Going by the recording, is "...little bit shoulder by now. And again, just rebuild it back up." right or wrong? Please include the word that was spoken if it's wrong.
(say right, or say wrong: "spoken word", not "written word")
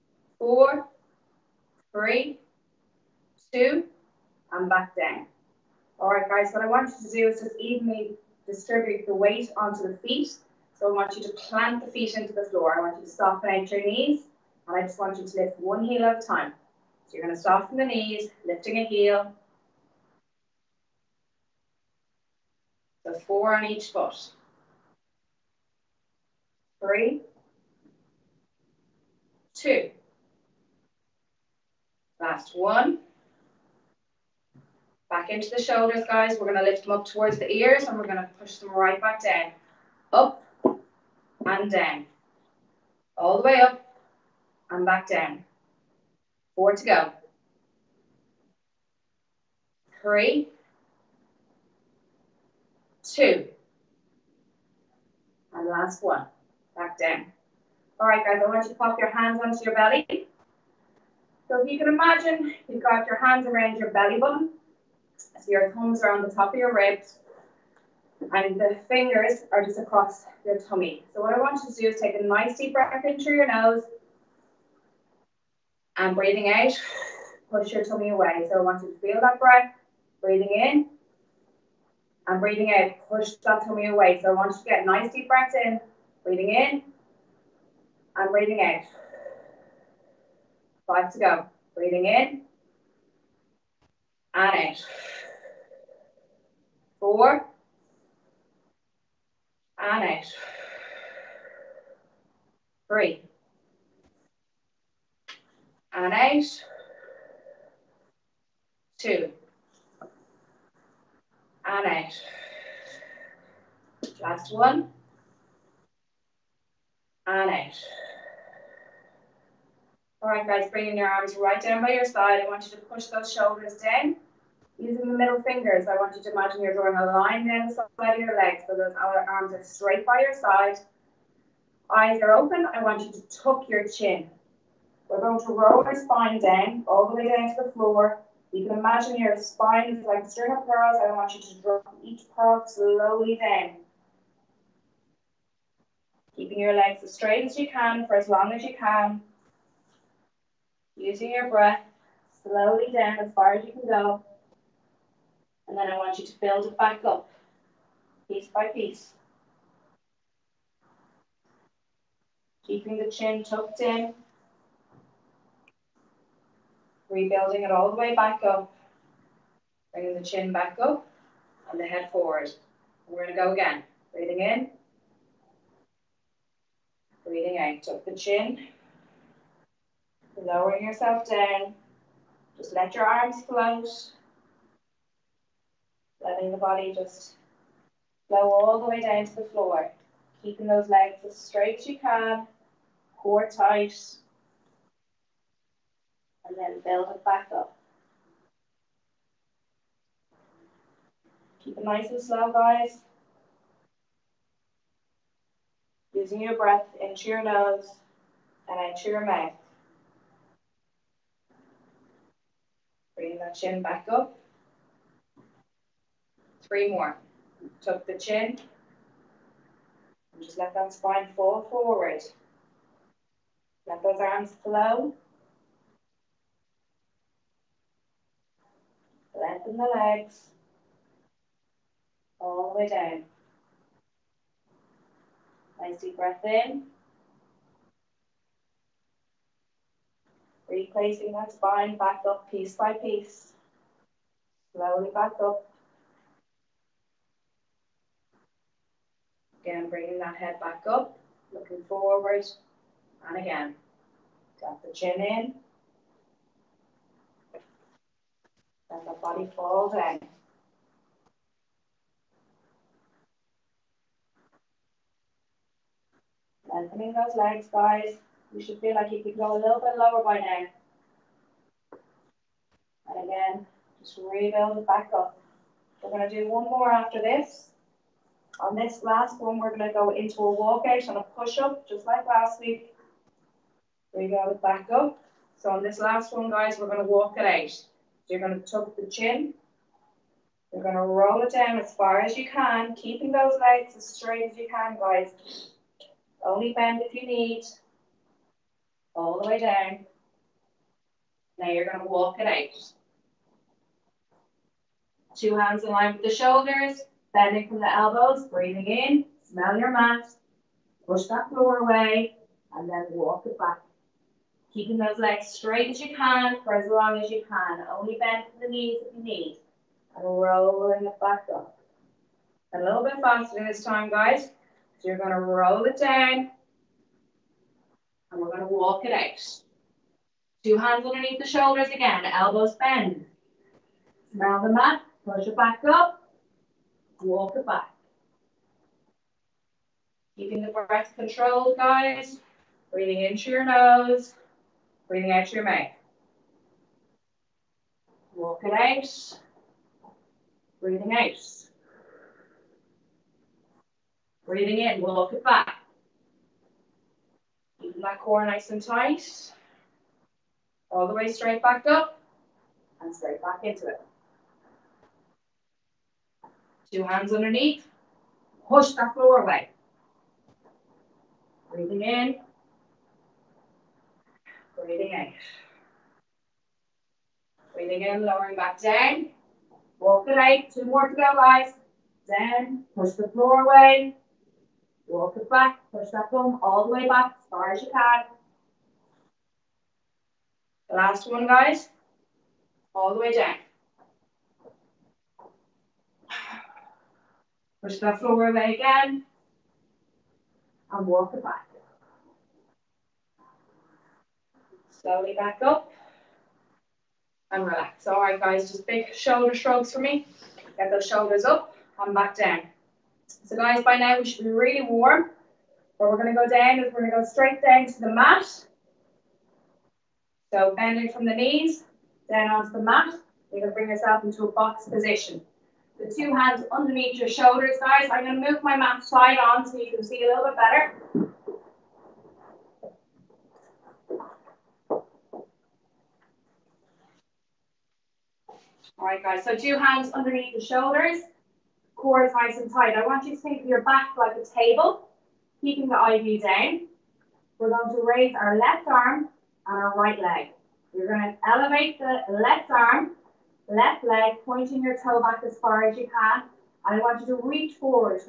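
wrong: "lower", not "shoulder".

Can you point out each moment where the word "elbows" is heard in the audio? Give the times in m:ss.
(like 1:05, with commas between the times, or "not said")
5:07, 5:32.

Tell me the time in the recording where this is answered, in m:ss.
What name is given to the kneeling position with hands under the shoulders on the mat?
7:04.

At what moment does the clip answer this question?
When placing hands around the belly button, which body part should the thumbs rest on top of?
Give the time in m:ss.
1:05.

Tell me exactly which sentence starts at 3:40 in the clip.
And just let that spine fall forward.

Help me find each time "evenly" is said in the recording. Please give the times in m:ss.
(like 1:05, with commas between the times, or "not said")
0:07.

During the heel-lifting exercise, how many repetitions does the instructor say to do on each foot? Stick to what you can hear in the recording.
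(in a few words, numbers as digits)
4.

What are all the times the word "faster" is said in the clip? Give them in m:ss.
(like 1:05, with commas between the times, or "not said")
5:23.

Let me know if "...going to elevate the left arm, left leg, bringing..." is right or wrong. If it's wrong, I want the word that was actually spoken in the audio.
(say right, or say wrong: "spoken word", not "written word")
wrong: "pointing", not "bringing".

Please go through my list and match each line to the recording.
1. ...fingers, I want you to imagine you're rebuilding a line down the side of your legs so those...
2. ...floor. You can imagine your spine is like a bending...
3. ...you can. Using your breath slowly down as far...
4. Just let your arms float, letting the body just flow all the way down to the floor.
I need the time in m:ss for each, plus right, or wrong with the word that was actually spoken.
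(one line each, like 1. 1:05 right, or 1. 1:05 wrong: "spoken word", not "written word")
1. 2:05 wrong: "drawing", not "rebuilding"
2. 2:17 wrong: "string", not "bending"
3. 2:28 right
4. 3:02 right.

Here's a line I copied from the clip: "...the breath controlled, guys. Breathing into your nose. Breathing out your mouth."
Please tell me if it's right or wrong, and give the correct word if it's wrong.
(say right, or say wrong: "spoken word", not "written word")
right.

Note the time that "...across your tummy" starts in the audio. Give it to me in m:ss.
1:09.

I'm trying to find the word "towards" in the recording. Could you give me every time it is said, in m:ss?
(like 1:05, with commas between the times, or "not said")
0:37.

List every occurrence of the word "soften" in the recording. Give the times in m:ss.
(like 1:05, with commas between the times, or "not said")
0:13, 0:17.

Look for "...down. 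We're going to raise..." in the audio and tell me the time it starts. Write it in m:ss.
7:26.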